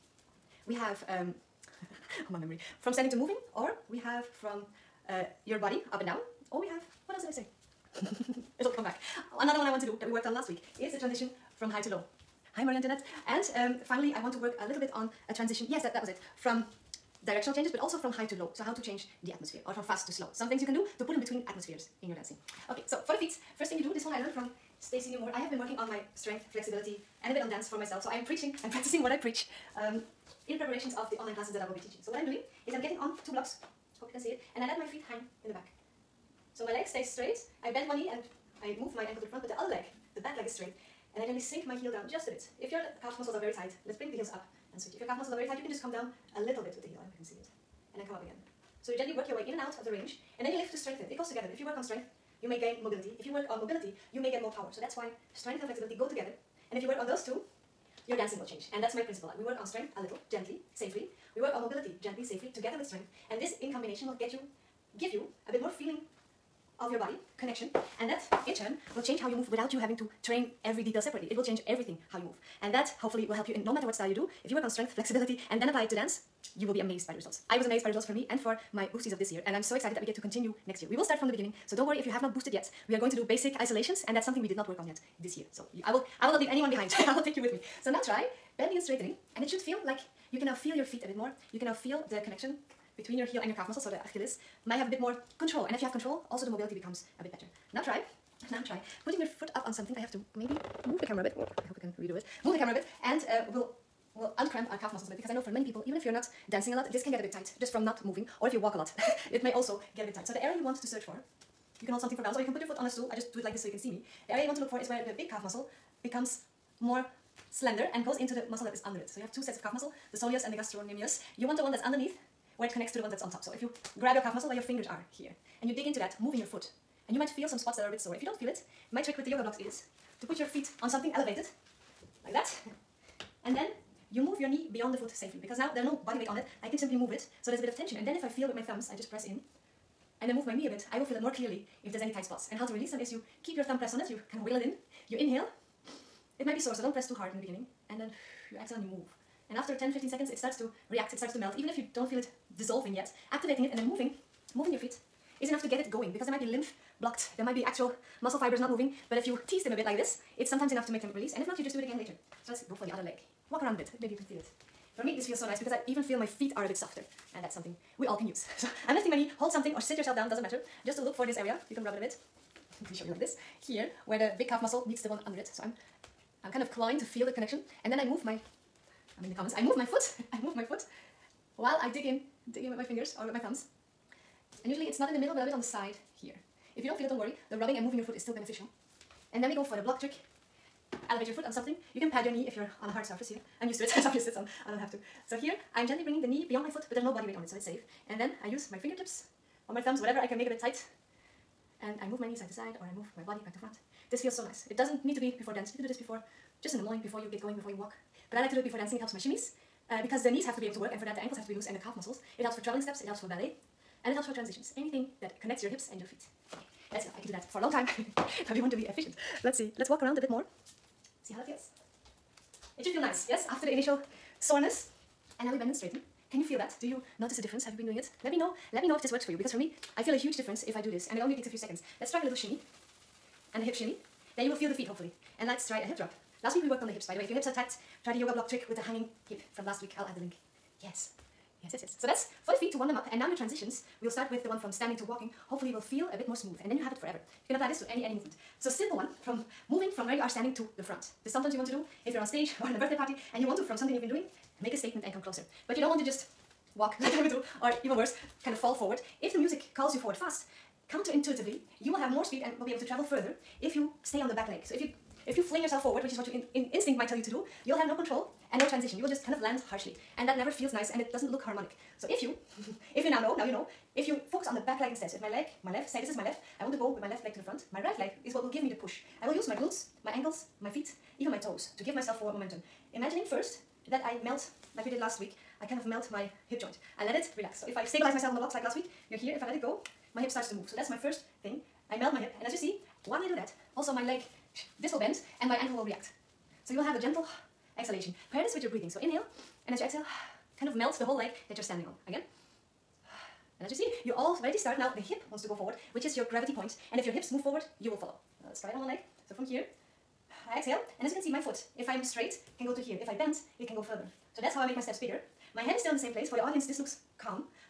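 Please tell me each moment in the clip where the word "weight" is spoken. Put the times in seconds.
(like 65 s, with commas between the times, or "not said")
136 s, 197 s.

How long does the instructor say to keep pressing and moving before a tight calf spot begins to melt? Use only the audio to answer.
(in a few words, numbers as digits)
10-15 seconds.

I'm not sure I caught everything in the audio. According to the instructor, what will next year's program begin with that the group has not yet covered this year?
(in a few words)
basic isolations.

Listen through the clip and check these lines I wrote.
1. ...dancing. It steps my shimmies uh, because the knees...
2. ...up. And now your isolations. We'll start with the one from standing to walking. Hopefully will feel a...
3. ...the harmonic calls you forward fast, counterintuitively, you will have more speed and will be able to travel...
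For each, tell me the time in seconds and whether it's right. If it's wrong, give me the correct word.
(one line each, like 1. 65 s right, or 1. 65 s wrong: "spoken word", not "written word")
1. 208 s wrong: "helps", not "steps"
2. 242 s wrong: "transitions", not "isolations"
3. 259 s wrong: "music", not "harmonic".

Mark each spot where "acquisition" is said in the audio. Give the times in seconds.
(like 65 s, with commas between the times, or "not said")
not said.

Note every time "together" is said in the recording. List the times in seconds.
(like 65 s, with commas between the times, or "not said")
51 s, 56 s, 62 s.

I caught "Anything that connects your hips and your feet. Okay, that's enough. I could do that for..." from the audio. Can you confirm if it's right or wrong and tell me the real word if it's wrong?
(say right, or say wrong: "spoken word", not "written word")
right.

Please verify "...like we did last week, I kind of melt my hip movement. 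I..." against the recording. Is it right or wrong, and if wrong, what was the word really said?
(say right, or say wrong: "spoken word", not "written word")
wrong: "joint", not "movement".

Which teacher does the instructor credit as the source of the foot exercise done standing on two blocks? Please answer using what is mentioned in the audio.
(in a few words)
Stacey Nemour.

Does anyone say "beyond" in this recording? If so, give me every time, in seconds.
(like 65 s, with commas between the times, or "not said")
134 s, 196 s.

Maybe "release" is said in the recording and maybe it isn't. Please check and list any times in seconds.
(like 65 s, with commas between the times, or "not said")
142 s, 161 s.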